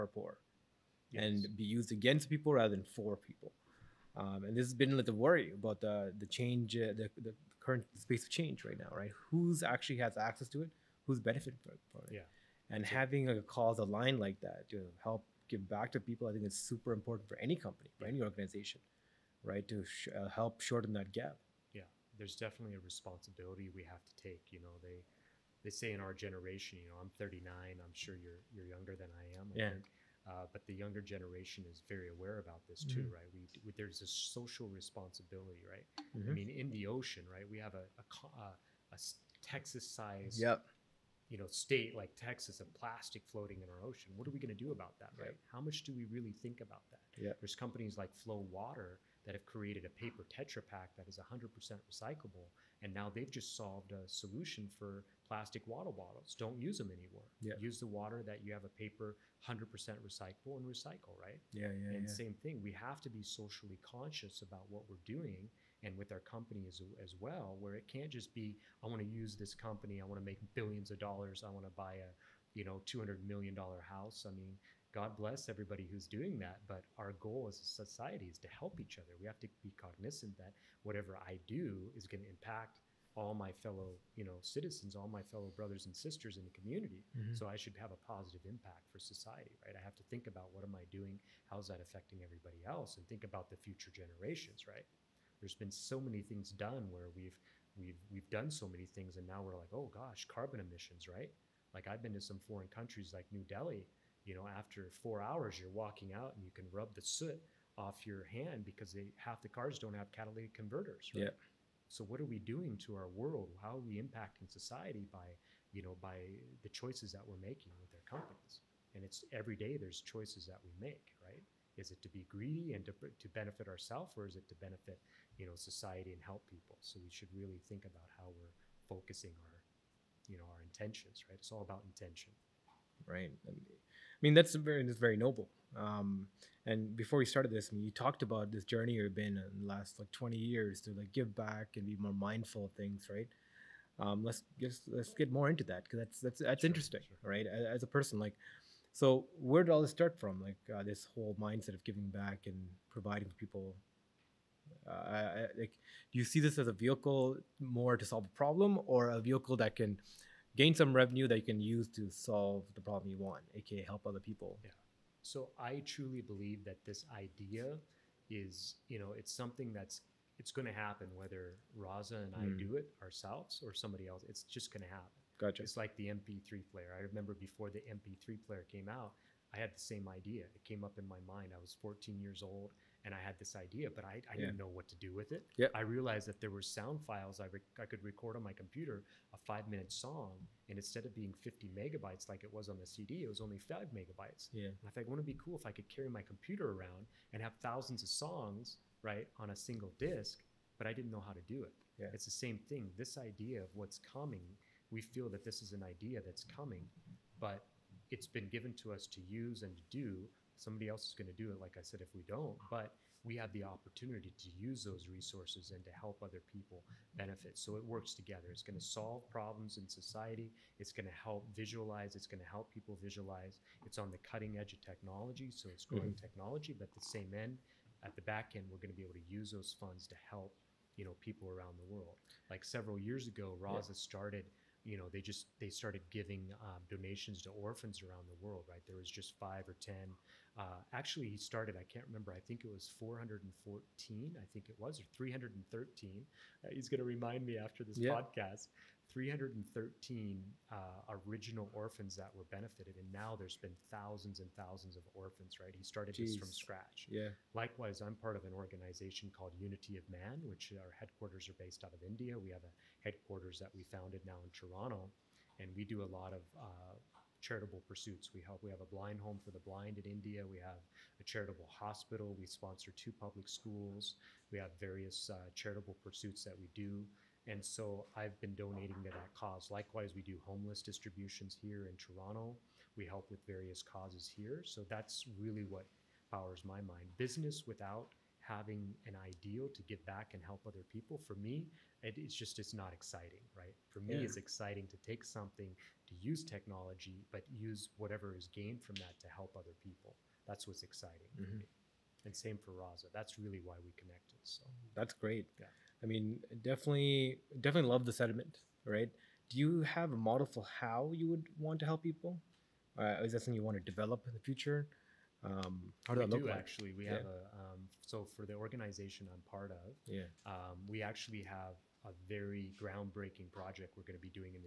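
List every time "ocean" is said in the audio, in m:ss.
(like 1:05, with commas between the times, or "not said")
0:36, 0:43.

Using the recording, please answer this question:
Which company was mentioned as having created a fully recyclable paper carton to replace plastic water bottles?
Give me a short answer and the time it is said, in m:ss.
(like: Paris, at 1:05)
Flow Water, at 0:48.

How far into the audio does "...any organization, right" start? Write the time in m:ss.
0:18.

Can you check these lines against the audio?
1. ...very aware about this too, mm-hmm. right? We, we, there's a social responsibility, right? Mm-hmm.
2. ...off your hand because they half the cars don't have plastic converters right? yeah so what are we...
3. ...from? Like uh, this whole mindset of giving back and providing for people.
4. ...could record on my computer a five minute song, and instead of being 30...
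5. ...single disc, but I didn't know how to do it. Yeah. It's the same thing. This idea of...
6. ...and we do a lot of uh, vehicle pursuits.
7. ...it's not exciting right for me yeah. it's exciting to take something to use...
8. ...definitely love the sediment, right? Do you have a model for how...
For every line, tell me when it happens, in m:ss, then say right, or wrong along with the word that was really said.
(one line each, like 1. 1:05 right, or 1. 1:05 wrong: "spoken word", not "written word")
1. 0:31 right
2. 1:47 wrong: "catalytic", not "plastic"
3. 2:30 right
4. 3:07 wrong: "50", not "30"
5. 3:19 right
6. 4:25 wrong: "charitable", not "vehicle"
7. 4:52 right
8. 5:07 right.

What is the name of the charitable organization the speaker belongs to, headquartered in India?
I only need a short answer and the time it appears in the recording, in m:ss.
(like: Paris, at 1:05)
Unity of Man, at 4:19.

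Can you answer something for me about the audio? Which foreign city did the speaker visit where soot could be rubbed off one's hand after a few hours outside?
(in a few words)
New Delhi.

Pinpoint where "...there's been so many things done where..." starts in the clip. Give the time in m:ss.
1:35.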